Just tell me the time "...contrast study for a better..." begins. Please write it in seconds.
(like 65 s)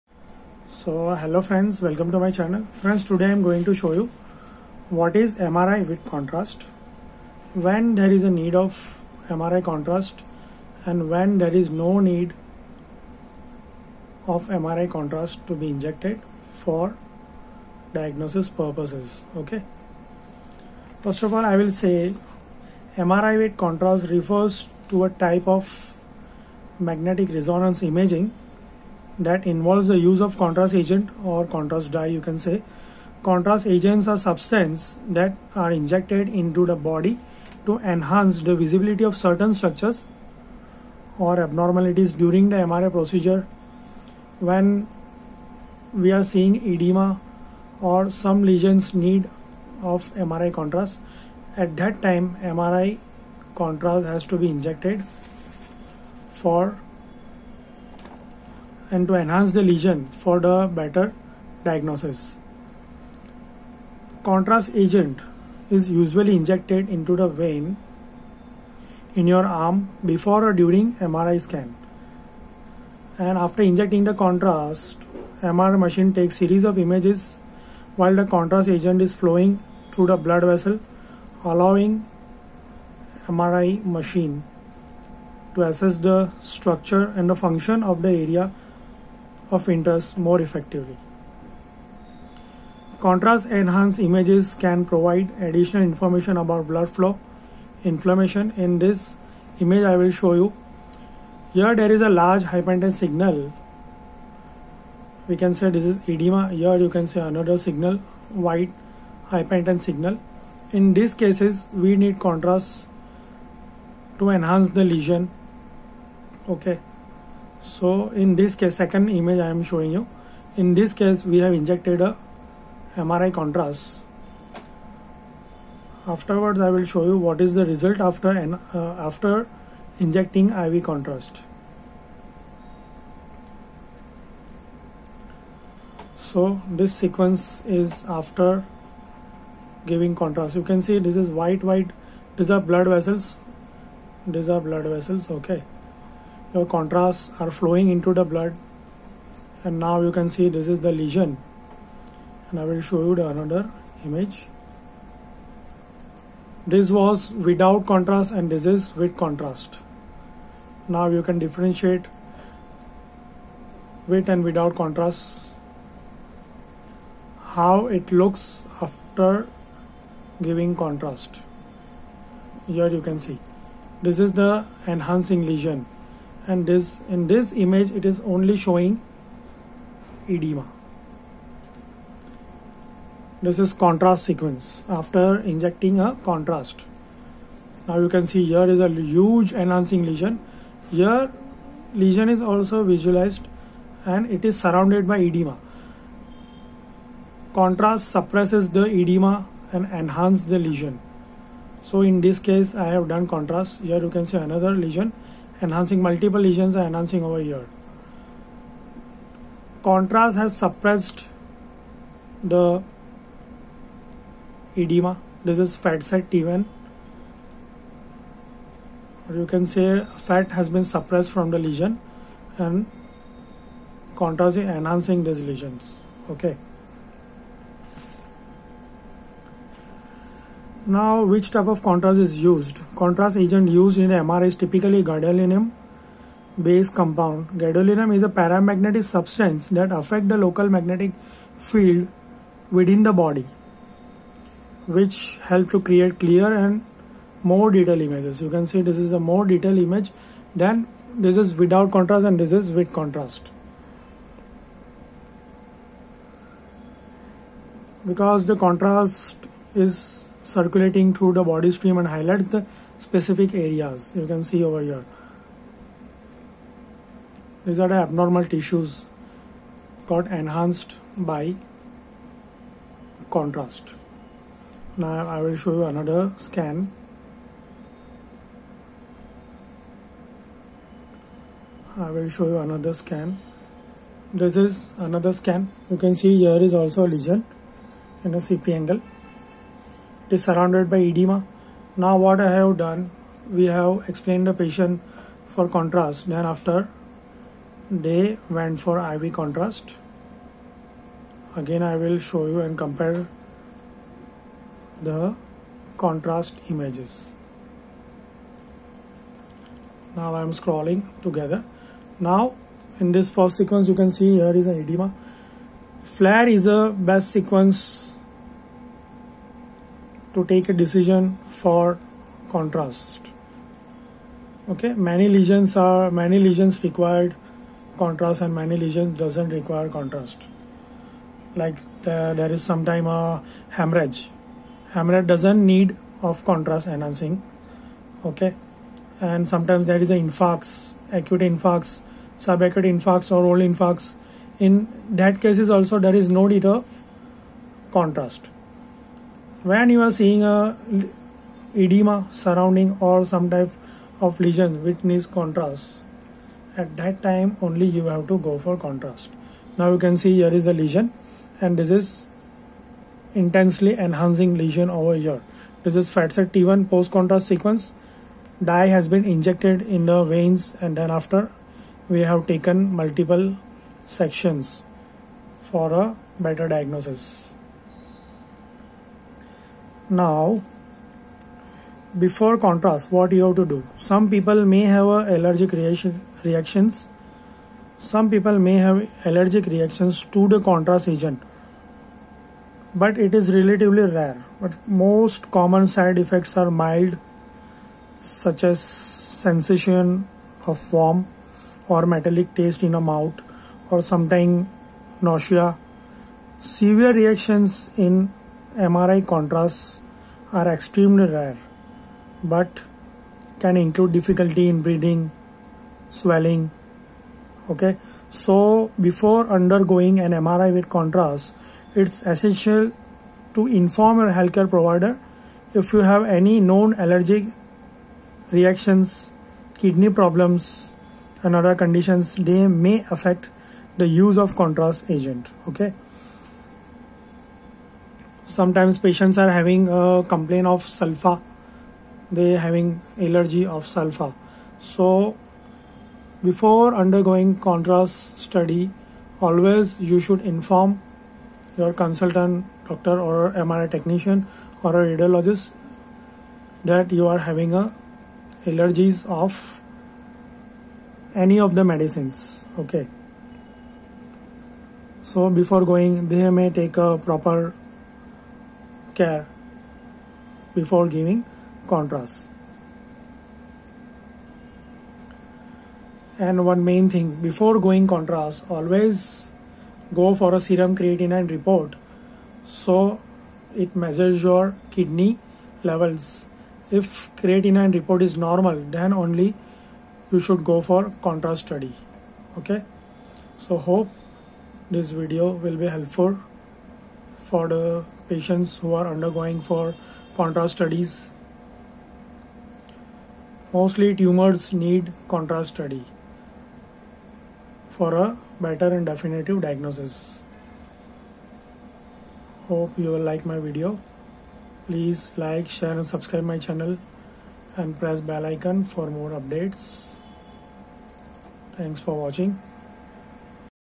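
505 s.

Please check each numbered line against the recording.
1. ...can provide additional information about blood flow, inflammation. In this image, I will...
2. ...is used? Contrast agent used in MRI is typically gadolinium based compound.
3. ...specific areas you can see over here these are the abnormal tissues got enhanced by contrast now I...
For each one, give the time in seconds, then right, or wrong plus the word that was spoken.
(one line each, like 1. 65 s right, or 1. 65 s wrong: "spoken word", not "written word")
1. 94 s right
2. 232 s right
3. 262 s right.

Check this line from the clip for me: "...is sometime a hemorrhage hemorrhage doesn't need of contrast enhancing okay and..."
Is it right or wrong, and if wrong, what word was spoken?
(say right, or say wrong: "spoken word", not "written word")
right.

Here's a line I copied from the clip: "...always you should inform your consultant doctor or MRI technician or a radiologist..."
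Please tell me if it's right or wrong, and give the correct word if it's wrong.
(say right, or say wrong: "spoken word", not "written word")
right.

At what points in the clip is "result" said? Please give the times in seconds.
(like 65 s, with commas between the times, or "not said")
127 s.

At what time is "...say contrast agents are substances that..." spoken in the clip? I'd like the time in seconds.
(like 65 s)
32 s.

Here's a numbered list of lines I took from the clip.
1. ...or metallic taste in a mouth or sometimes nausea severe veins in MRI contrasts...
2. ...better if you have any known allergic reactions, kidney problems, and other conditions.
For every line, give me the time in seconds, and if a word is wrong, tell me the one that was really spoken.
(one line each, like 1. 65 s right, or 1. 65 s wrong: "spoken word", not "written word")
1. 401 s wrong: "reactions", not "veins"
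2. 424 s wrong: "provider", not "better".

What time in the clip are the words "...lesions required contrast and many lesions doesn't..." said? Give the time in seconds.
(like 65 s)
326 s.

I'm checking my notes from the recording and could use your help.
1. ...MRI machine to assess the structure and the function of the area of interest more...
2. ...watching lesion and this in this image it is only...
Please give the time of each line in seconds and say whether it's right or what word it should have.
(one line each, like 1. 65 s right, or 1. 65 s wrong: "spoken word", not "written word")
1. 83 s right
2. 174 s wrong: "enhancing", not "watching".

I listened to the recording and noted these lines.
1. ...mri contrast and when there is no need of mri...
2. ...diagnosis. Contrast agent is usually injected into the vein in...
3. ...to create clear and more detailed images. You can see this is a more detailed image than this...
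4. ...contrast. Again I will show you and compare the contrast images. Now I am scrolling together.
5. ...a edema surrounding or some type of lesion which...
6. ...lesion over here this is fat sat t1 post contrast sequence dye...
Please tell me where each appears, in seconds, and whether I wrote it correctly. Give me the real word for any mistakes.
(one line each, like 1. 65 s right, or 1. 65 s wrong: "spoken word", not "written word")
1. 9 s right
2. 61 s right
3. 245 s right
4. 299 s right
5. 350 s right
6. 364 s right.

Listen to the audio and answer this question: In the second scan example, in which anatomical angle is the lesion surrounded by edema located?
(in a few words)
CP angle.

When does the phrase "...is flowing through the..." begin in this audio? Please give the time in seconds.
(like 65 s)
79 s.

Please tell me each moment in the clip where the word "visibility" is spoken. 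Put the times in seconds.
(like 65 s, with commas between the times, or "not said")
38 s.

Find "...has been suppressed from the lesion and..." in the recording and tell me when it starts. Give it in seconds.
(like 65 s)
220 s.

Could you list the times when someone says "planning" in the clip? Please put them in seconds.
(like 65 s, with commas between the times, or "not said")
not said.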